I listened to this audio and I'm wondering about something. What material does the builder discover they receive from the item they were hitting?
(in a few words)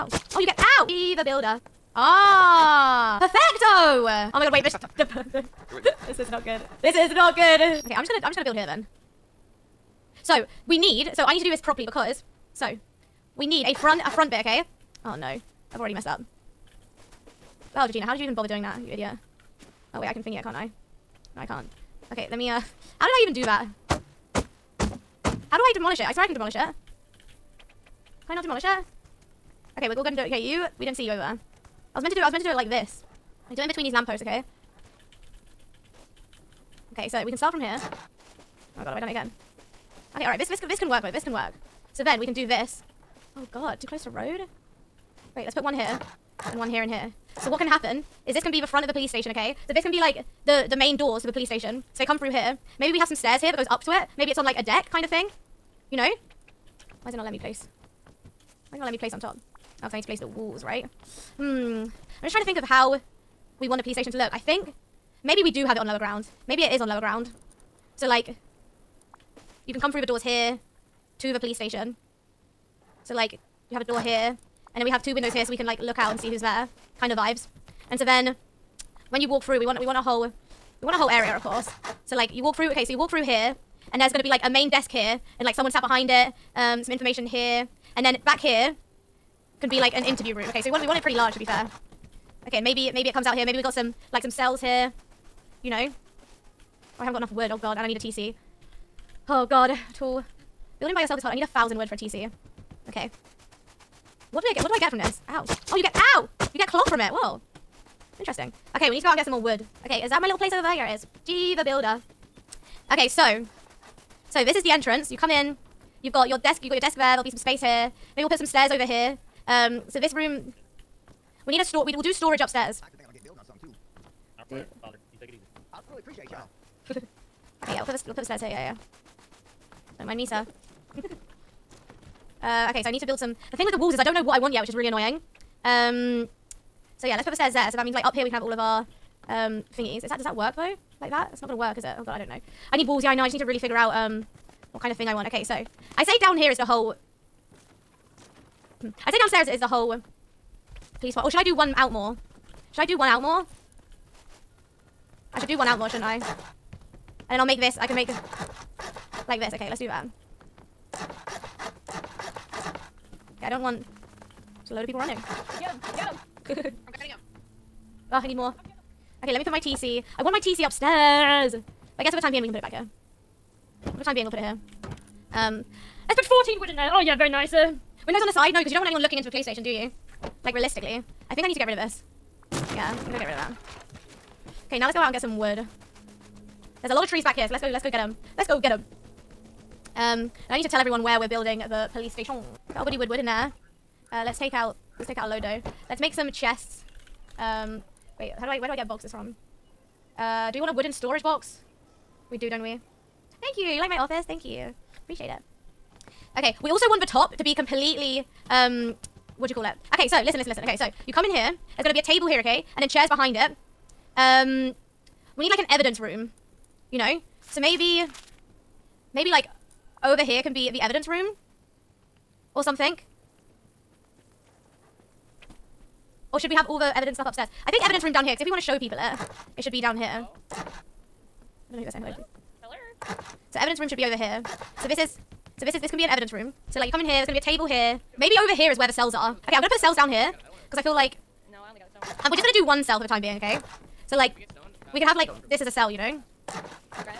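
Cloth.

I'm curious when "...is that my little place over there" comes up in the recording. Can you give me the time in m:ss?
1:50.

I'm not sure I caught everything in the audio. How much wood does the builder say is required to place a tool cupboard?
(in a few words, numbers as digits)
1000.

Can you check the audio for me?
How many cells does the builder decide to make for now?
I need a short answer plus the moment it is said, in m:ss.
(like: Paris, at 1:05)
1, at 4:02.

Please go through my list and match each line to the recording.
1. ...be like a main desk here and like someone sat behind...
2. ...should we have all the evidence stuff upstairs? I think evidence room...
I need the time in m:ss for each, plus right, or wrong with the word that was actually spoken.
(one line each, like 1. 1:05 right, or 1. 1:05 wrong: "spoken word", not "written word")
1. 1:24 right
2. 3:46 right.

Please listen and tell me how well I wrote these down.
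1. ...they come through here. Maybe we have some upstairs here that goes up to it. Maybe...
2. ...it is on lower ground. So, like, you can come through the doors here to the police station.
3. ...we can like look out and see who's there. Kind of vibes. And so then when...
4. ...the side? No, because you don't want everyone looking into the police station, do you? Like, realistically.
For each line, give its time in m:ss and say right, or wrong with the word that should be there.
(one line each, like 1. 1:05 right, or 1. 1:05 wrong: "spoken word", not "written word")
1. 0:52 wrong: "stairs", not "upstairs"
2. 1:06 right
3. 1:15 right
4. 2:58 wrong: "anyone", not "everyone".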